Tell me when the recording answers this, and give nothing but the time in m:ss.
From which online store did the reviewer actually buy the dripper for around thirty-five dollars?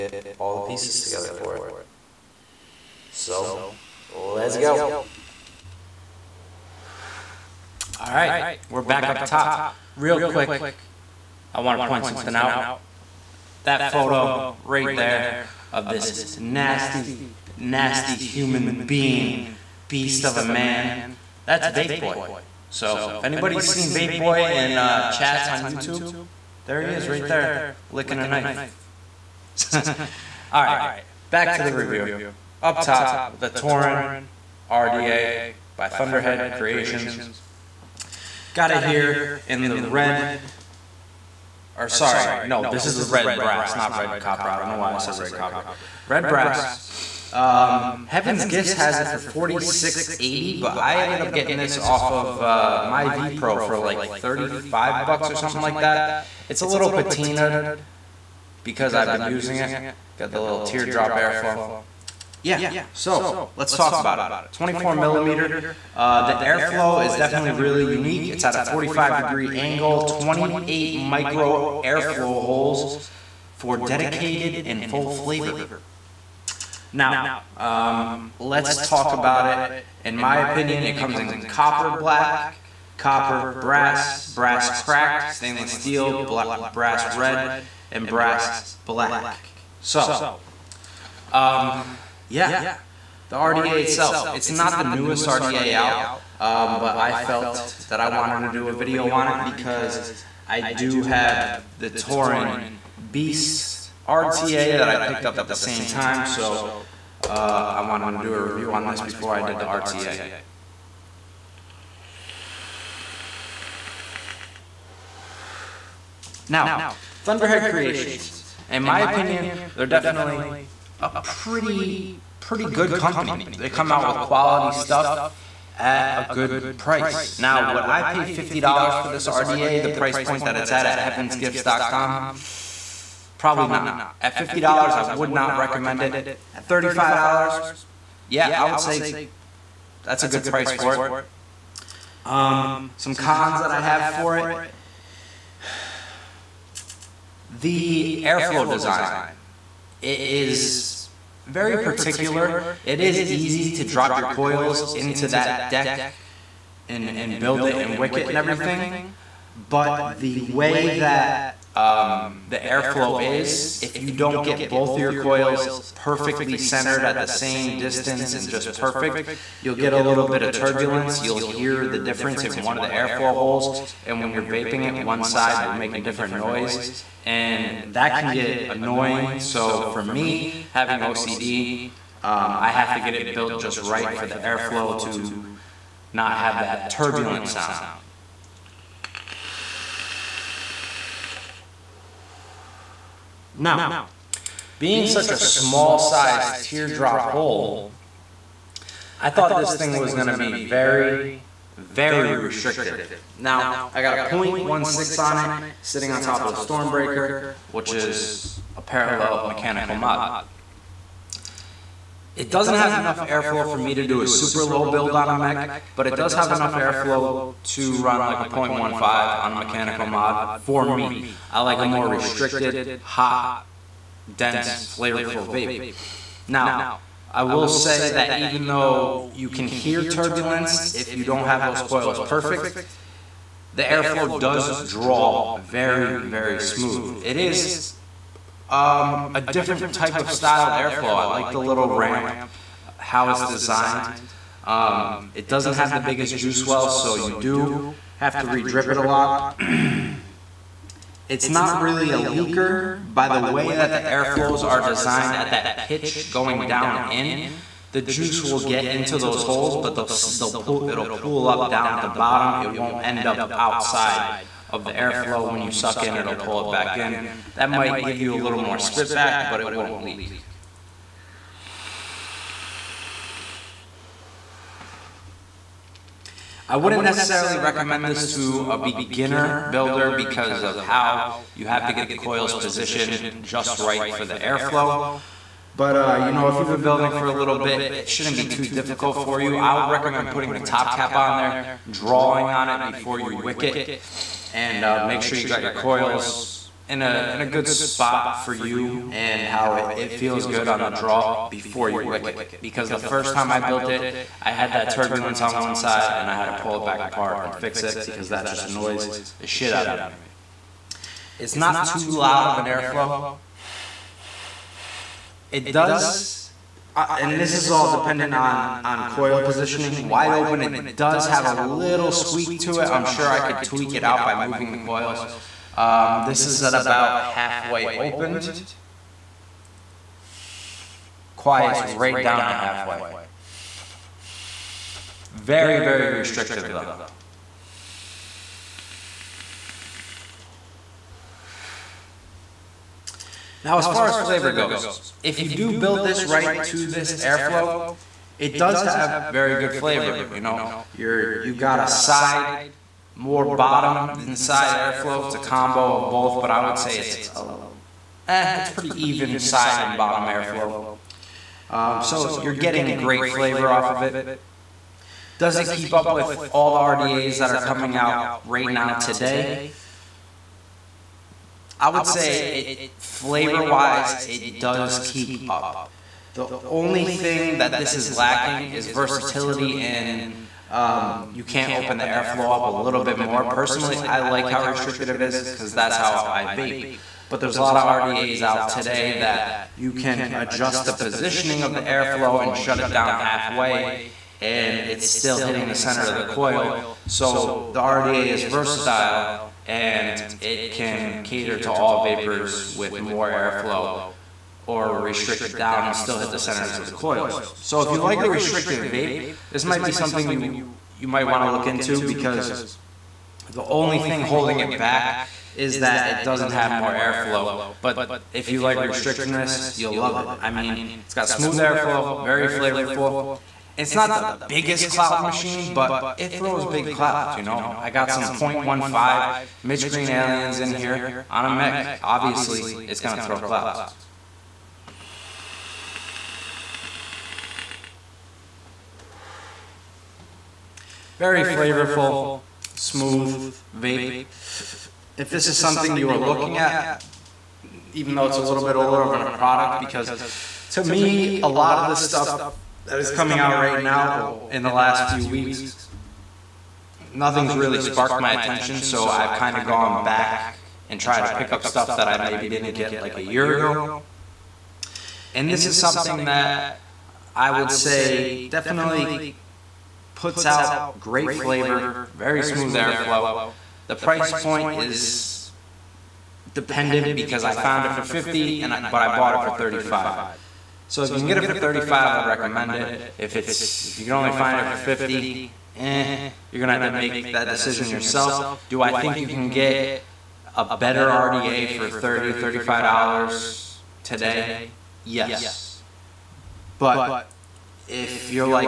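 0:52.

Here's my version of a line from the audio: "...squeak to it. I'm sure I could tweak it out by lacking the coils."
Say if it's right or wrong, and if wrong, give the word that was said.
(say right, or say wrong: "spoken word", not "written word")
wrong: "moving", not "lacking".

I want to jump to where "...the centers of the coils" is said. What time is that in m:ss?
6:46.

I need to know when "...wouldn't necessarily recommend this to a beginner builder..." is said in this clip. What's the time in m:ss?
4:36.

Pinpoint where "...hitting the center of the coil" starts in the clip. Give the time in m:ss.
6:35.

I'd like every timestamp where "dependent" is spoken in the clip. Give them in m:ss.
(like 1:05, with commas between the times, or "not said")
5:17, 7:56.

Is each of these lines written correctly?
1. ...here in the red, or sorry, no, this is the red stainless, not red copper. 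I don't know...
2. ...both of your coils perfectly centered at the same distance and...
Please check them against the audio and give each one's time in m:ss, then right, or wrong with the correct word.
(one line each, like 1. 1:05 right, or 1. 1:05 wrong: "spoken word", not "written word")
1. 0:38 wrong: "brass", not "stainless"
2. 2:44 right.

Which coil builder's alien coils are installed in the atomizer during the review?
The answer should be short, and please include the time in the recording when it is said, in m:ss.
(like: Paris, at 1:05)
Mitch Green, at 7:09.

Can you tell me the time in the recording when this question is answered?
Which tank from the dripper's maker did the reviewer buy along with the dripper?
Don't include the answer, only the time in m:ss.
1:41.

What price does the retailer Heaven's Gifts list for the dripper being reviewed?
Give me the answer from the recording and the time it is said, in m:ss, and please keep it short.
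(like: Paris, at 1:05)
$46.80, at 0:49.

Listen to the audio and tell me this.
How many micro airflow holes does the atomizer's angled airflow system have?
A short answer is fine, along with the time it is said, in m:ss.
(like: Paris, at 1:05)
28, at 1:10.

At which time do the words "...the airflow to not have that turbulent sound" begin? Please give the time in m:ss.
3:04.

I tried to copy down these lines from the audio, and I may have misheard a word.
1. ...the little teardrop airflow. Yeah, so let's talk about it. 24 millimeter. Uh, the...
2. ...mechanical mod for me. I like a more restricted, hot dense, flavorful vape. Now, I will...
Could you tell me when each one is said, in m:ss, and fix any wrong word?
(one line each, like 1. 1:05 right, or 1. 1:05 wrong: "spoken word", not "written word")
1. 1:00 right
2. 3:39 right.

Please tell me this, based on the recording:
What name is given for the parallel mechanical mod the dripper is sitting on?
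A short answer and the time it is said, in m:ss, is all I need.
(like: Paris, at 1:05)
Stormbreaker, at 3:26.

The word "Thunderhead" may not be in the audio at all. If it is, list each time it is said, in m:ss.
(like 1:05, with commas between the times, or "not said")
0:35, 1:57.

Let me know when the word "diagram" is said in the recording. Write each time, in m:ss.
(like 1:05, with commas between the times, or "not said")
not said.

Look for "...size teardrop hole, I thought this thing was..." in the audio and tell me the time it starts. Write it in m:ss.
3:15.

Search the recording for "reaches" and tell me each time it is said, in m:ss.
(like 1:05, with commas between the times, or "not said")
not said.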